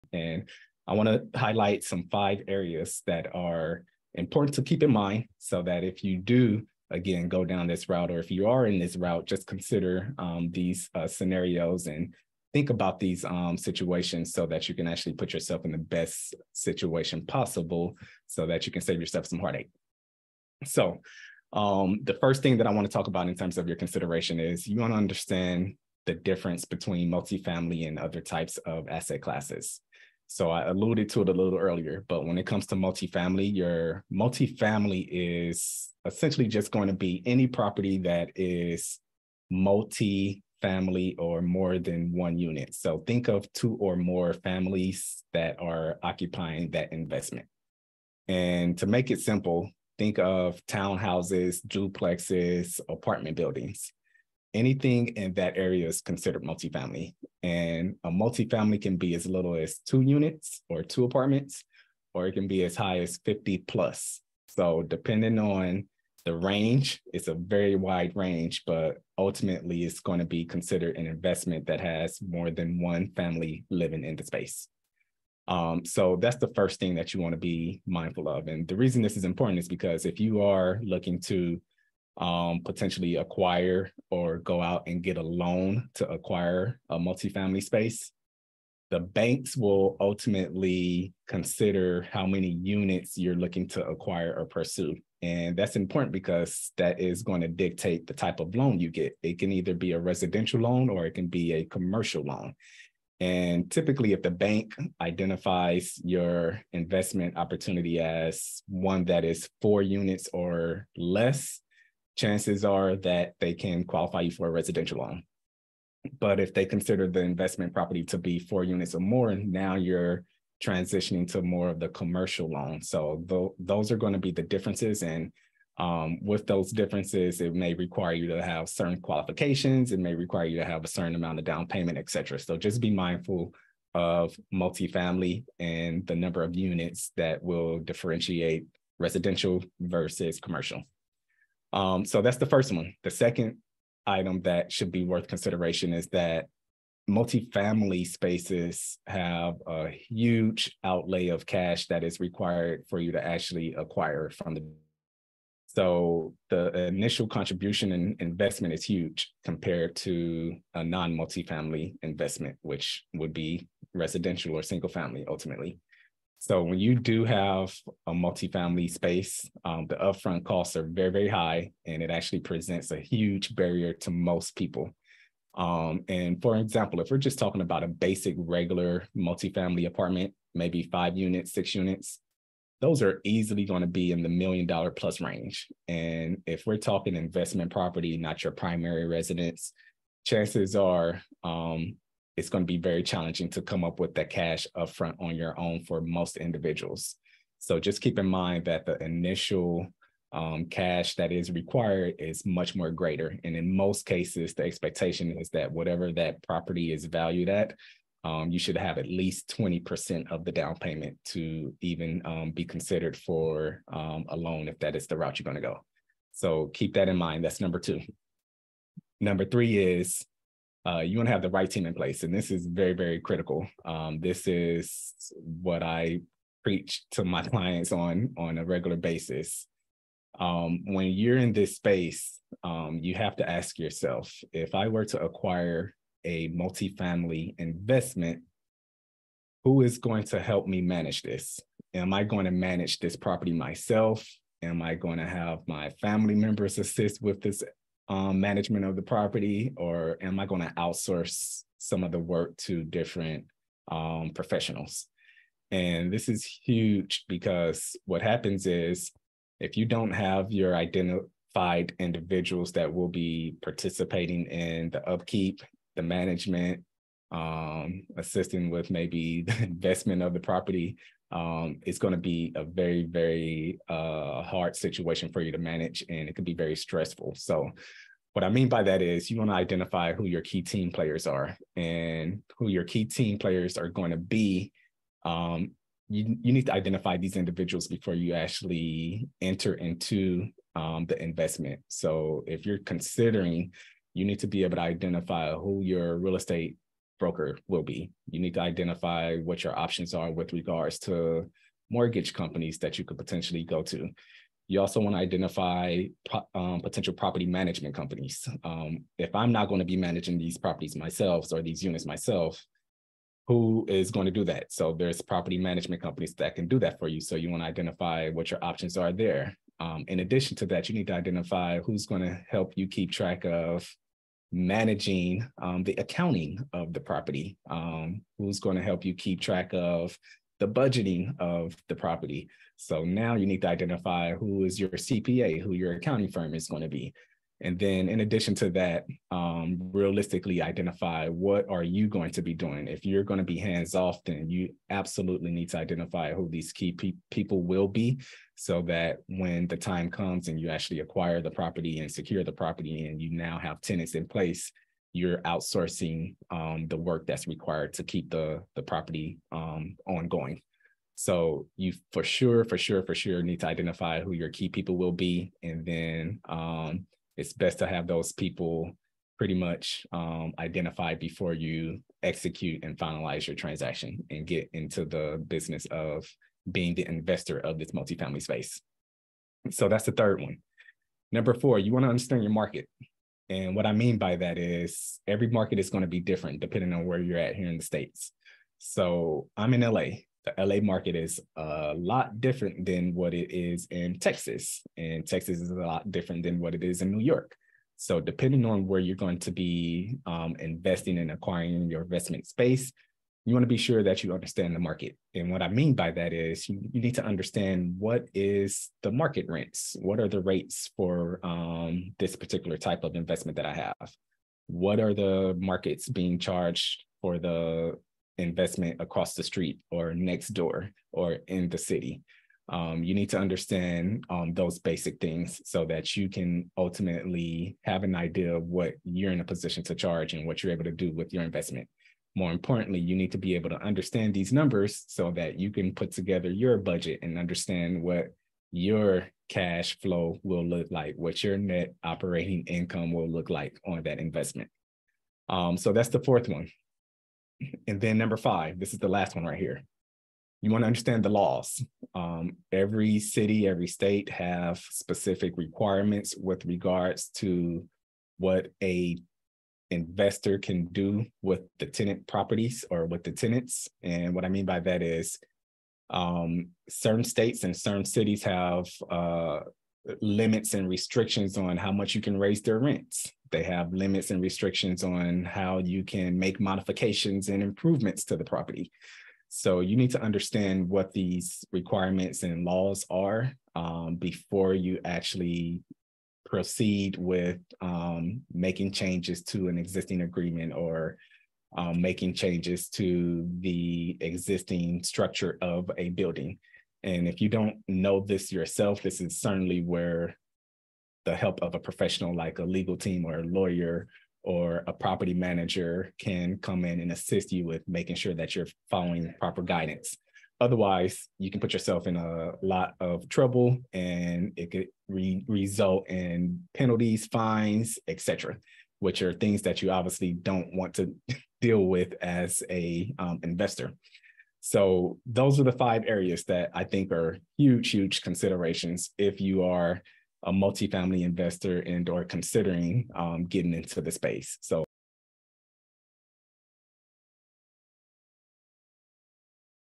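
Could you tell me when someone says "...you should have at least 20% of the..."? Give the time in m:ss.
3:28.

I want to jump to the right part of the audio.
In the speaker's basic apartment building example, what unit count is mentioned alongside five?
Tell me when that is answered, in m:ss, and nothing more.
3:01.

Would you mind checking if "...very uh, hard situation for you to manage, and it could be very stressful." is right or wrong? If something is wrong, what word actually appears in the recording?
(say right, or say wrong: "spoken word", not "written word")
right.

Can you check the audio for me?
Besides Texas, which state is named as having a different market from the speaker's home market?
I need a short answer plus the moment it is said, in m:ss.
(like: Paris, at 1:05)
New York, at 6:37.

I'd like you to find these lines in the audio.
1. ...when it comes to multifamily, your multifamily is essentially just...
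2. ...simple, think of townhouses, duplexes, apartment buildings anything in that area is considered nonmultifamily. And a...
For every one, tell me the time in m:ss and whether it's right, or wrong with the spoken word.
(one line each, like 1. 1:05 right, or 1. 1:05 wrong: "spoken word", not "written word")
1. 0:32 right
2. 0:49 wrong: "multifamily", not "nonmultifamily".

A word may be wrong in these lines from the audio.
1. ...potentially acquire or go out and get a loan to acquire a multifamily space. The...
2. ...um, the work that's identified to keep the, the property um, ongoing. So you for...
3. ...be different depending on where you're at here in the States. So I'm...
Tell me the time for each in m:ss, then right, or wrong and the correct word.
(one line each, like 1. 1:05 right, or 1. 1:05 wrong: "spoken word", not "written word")
1. 1:22 right
2. 5:56 wrong: "required", not "identified"
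3. 6:26 right.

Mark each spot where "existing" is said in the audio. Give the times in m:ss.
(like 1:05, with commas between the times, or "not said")
8:09, 8:14.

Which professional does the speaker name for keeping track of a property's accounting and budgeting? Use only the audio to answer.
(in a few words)
CPA.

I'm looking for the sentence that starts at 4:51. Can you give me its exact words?
So, if you're considering, you need to be able to identify who your real estate broker will be.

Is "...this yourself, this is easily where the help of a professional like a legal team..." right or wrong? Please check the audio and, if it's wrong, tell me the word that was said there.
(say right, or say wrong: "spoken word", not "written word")
wrong: "certainly", not "easily".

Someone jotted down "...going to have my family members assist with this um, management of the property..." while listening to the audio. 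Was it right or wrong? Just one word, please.
right.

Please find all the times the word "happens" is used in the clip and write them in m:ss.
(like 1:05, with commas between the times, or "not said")
4:18.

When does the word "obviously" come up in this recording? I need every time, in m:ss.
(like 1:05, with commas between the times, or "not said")
8:39.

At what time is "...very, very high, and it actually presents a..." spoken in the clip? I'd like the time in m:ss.
2:50.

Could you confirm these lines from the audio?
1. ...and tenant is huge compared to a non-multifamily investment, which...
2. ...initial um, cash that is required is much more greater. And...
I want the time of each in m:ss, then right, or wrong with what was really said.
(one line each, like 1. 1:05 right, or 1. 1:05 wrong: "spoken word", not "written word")
1. 2:37 wrong: "investment", not "tenant"
2. 3:19 right.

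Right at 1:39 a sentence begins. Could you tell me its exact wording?
It can either be a residential loan or it can be a commercial loan.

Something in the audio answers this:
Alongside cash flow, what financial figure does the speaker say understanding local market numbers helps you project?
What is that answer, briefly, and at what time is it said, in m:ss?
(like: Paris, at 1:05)
net operating income, at 7:21.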